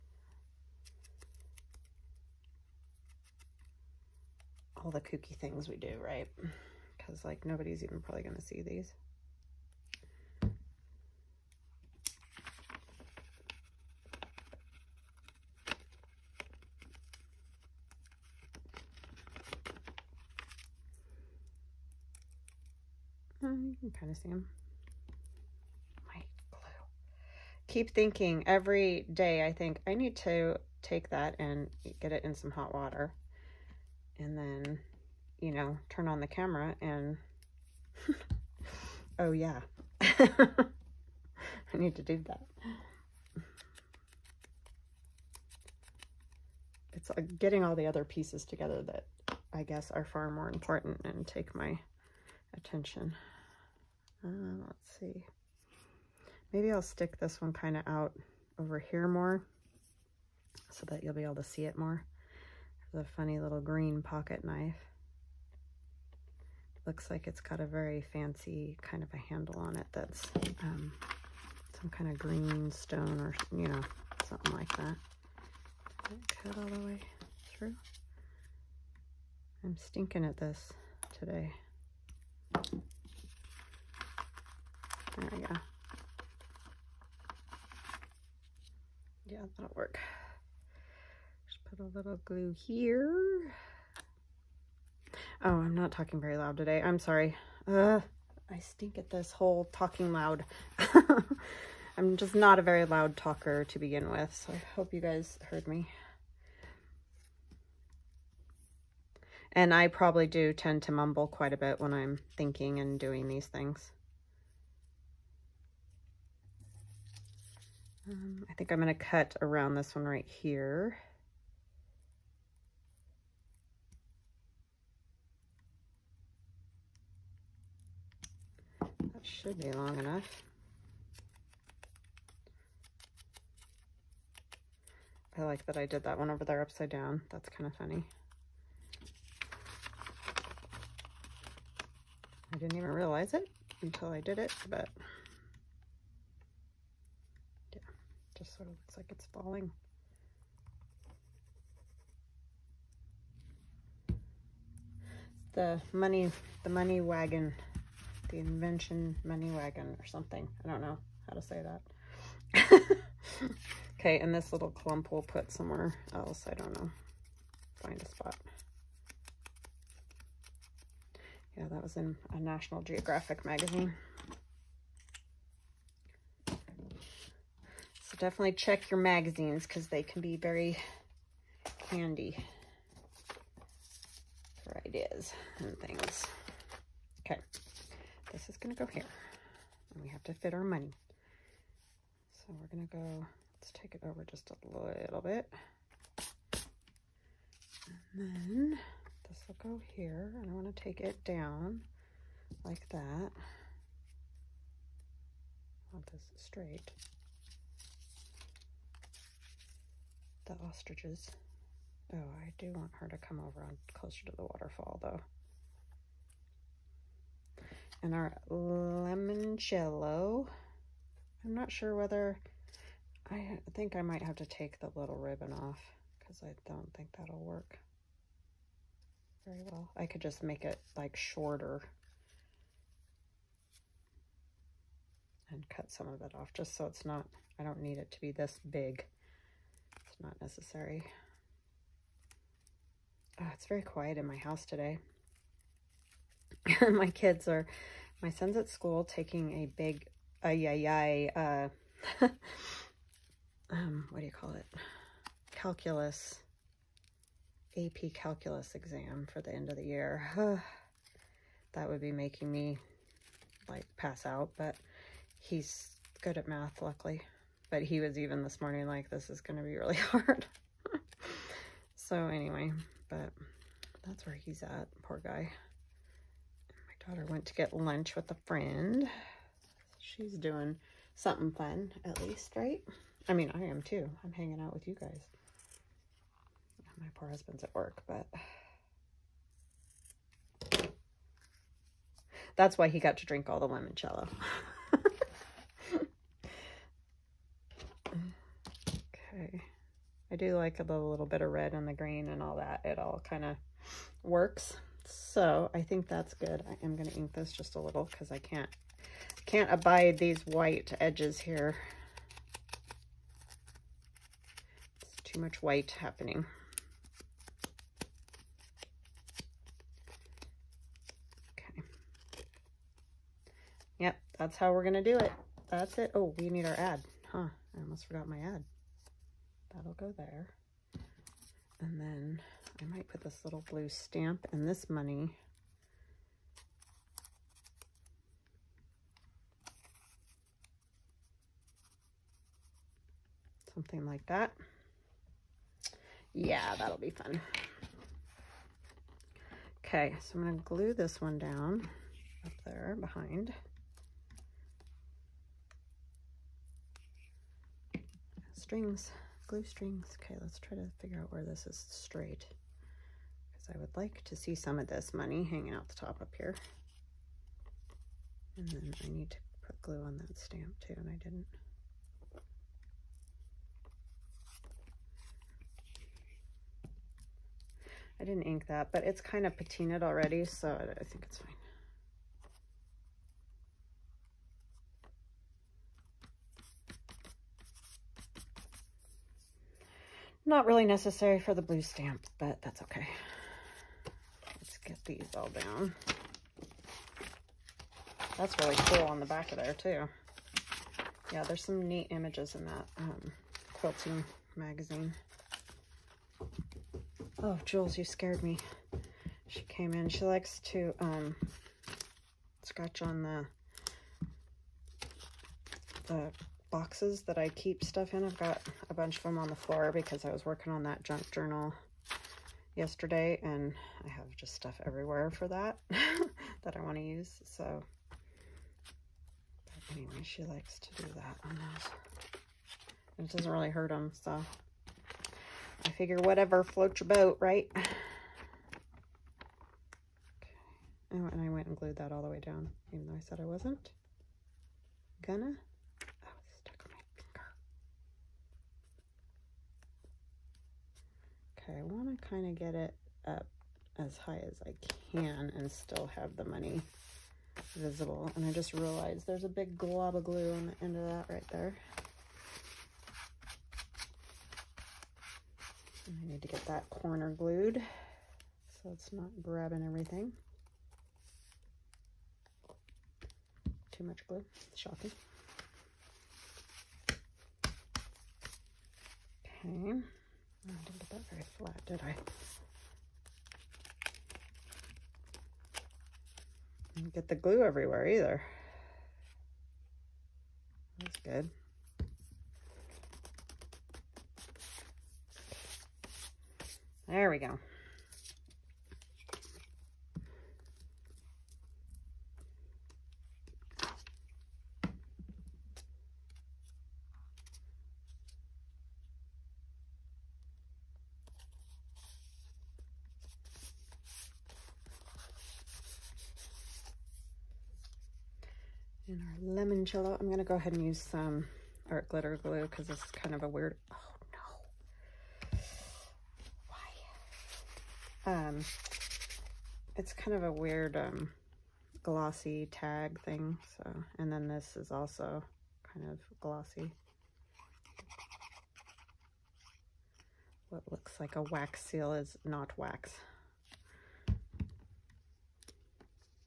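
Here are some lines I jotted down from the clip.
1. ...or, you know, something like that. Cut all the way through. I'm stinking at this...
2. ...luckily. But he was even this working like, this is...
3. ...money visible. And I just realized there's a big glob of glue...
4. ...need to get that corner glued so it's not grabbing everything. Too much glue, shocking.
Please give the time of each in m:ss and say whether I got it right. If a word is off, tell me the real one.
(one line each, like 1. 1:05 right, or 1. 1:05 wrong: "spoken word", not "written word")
1. 1:13 right
2. 4:26 wrong: "morning", not "working"
3. 7:36 right
4. 7:46 right.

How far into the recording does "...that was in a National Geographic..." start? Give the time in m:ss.
2:51.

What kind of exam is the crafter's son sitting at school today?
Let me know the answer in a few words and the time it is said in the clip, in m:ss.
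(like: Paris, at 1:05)
AP calculus, at 4:17.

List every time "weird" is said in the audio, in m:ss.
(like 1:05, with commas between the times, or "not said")
8:43, 8:50.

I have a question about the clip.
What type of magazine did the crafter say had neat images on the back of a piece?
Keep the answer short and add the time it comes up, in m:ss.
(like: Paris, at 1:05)
Quilting magazine, at 6:43.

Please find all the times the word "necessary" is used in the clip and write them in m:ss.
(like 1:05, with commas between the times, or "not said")
4:00, 6:30.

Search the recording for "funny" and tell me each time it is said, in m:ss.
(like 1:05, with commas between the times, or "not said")
1:03, 2:17.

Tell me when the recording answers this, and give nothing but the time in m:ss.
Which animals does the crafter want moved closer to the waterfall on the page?
3:30.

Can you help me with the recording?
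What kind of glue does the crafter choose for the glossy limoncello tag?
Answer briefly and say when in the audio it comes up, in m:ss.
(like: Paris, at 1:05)
Art glitter glue, at 8:41.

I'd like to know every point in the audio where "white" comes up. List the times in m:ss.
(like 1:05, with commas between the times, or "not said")
5:10, 5:15.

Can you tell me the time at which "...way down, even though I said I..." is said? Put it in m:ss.
7:22.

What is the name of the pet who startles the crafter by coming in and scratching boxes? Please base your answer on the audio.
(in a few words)
Jules.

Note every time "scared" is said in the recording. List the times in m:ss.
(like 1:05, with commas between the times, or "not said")
6:48.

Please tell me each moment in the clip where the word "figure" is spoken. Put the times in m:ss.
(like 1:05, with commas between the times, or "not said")
6:01, 7:15.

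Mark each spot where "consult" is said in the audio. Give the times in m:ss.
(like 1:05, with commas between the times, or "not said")
not said.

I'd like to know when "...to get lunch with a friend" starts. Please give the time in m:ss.
4:37.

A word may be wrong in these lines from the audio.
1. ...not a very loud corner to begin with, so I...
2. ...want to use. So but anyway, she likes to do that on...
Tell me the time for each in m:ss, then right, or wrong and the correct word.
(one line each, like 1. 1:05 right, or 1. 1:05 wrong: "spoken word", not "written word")
1. 1:42 wrong: "talker", not "corner"
2. 7:06 right.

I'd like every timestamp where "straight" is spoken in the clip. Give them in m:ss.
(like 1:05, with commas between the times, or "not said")
3:26, 6:01.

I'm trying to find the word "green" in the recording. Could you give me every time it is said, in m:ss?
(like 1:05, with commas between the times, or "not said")
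1:03, 1:12, 5:01.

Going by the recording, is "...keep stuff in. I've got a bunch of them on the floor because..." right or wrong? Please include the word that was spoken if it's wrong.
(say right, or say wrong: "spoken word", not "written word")
right.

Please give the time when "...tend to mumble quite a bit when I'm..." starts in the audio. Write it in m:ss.
1:50.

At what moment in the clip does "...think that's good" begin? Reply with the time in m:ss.
5:05.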